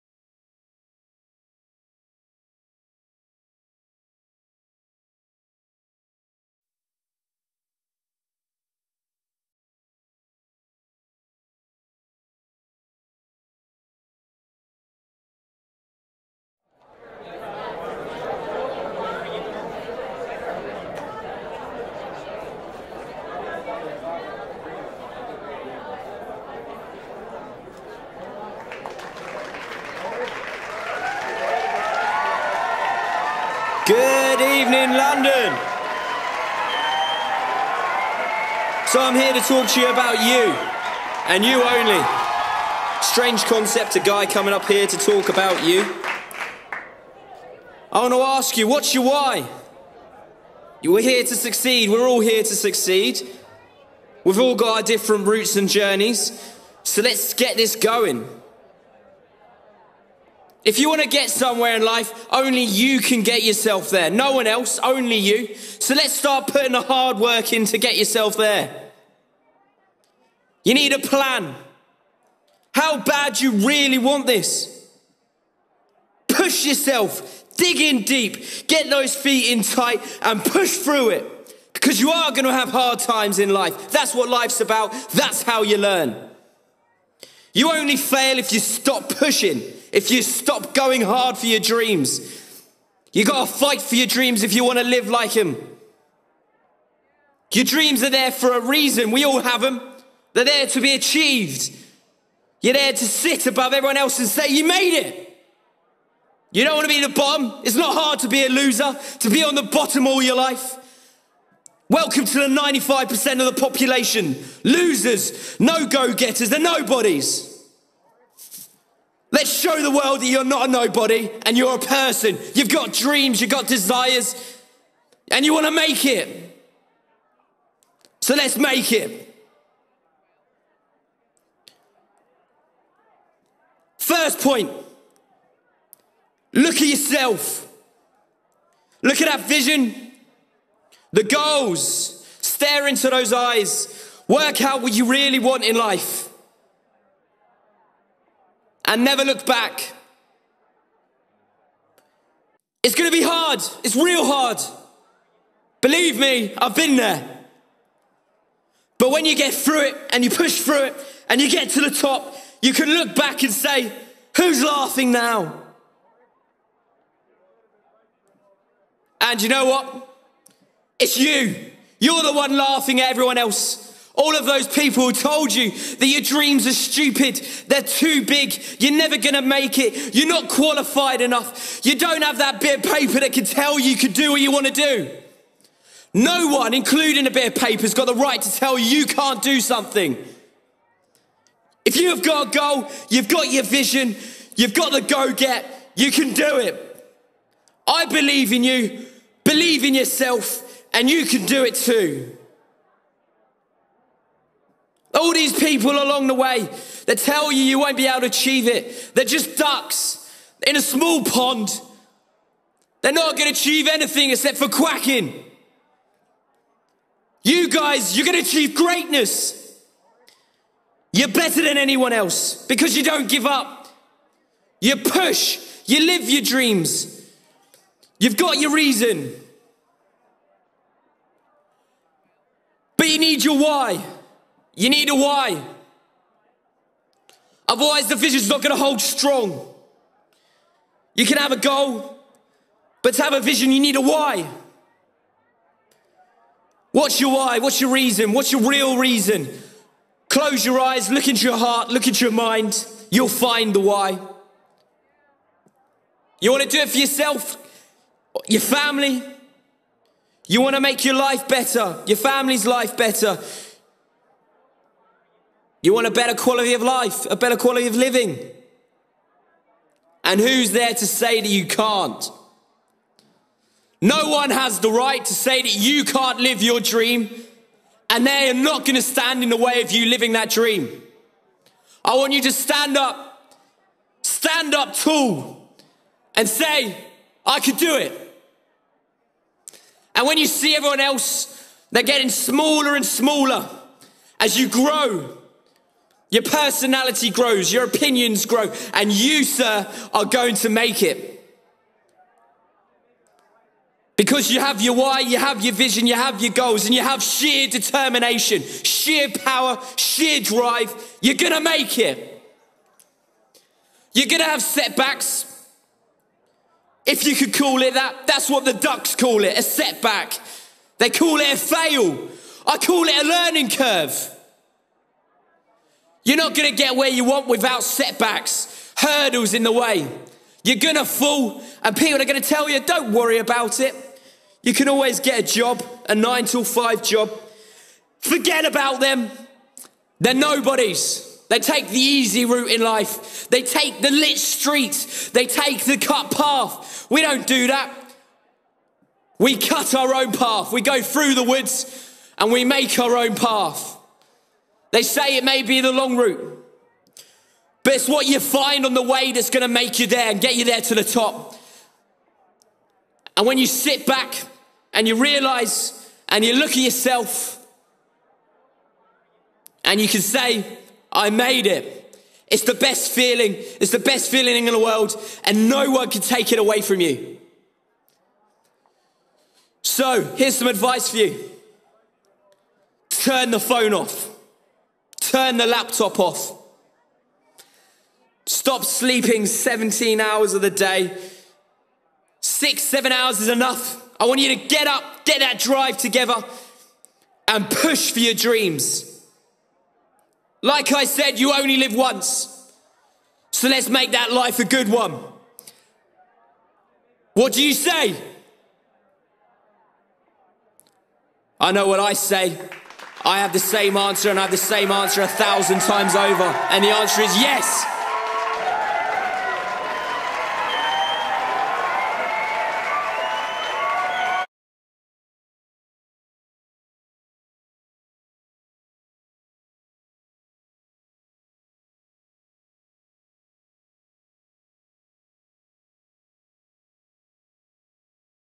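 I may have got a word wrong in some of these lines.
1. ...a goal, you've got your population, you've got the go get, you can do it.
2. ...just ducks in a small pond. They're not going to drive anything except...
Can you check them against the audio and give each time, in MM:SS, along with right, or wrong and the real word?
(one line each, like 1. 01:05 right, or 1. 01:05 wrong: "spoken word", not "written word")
1. 03:12 wrong: "vision", not "population"
2. 03:29 wrong: "achieve", not "drive".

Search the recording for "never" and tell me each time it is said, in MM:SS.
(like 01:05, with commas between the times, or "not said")
02:29, 02:58.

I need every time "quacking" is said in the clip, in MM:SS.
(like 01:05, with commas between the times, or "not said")
03:34.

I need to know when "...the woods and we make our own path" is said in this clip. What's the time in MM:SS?
05:51.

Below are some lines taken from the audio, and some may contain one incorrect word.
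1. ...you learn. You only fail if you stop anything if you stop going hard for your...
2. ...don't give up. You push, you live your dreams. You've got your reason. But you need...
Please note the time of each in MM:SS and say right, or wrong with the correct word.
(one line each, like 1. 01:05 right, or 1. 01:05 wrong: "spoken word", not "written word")
1. 01:25 wrong: "pushing", not "anything"
2. 03:43 right.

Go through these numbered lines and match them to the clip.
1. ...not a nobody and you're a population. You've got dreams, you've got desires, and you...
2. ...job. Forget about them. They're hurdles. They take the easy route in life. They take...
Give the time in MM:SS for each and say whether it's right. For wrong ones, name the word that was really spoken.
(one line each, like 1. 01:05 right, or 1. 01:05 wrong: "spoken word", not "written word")
1. 02:00 wrong: "person", not "population"
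2. 05:37 wrong: "nobodies", not "hurdles".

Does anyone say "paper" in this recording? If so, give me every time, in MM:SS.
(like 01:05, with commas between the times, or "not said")
03:02, 03:07.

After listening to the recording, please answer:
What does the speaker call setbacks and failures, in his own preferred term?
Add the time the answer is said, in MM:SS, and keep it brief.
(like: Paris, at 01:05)
A learning curve, at 05:23.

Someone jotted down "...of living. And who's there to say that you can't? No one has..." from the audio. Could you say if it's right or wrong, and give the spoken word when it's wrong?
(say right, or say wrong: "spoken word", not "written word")
right.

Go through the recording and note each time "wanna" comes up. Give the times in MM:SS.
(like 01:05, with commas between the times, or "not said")
01:34, 01:46, 03:04.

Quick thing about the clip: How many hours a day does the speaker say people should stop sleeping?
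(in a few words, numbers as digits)
17.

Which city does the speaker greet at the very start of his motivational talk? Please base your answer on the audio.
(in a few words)
London.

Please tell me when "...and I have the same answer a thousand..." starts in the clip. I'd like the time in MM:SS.
06:54.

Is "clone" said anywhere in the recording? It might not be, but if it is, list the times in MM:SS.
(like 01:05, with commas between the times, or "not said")
not said.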